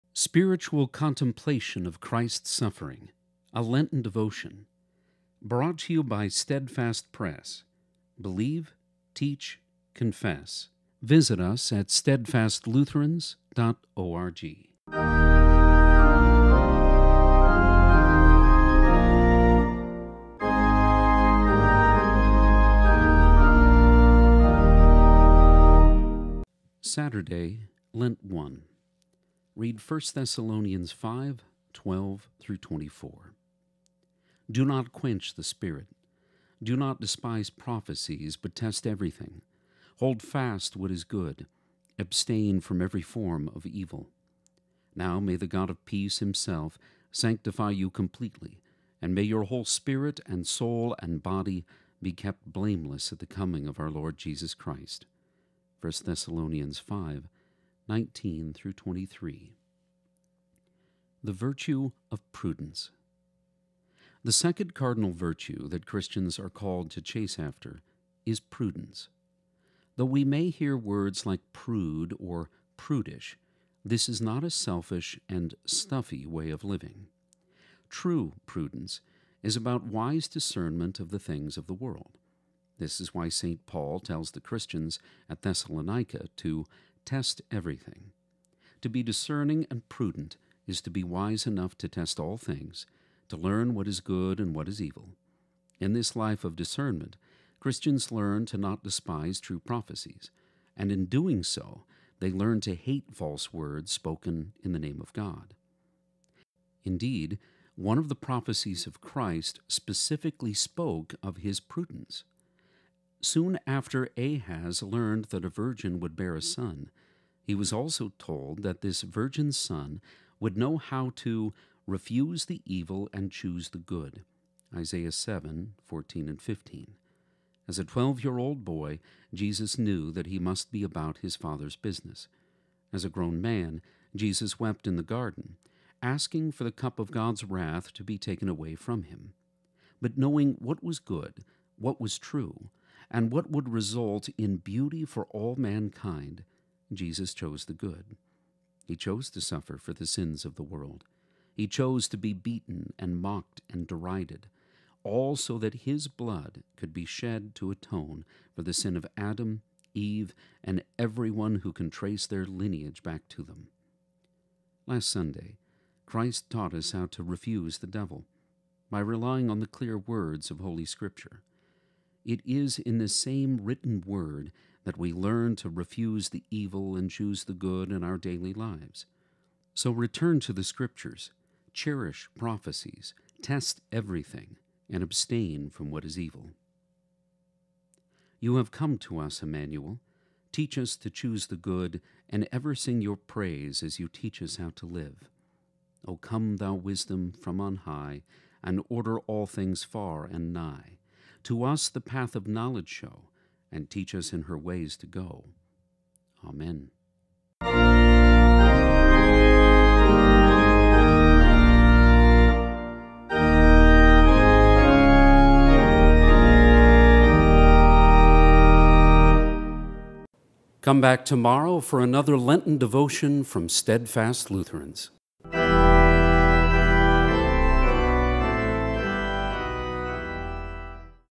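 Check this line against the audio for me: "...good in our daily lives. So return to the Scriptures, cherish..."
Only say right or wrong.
right.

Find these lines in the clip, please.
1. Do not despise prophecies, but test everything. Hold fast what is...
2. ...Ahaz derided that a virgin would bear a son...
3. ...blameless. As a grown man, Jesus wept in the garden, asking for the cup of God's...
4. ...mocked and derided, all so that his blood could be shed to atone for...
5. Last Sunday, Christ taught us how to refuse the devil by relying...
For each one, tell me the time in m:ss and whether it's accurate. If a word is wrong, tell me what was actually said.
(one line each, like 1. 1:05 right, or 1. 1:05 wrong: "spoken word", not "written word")
1. 0:36 right
2. 1:54 wrong: "learned", not "derided"
3. 2:11 wrong: "business", not "blameless"
4. 2:33 right
5. 2:44 right.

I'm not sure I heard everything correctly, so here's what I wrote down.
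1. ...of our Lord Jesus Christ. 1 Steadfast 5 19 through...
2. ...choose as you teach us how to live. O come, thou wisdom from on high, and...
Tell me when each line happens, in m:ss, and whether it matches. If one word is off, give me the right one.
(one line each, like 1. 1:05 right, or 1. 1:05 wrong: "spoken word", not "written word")
1. 0:53 wrong: "Thessalonians", not "Steadfast"
2. 3:13 wrong: "praise", not "choose".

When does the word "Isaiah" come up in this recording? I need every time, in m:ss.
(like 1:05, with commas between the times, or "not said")
2:04.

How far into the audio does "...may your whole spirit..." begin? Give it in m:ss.
0:49.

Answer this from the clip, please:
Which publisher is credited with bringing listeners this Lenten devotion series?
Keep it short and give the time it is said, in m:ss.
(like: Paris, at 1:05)
Steadfast Press, at 0:06.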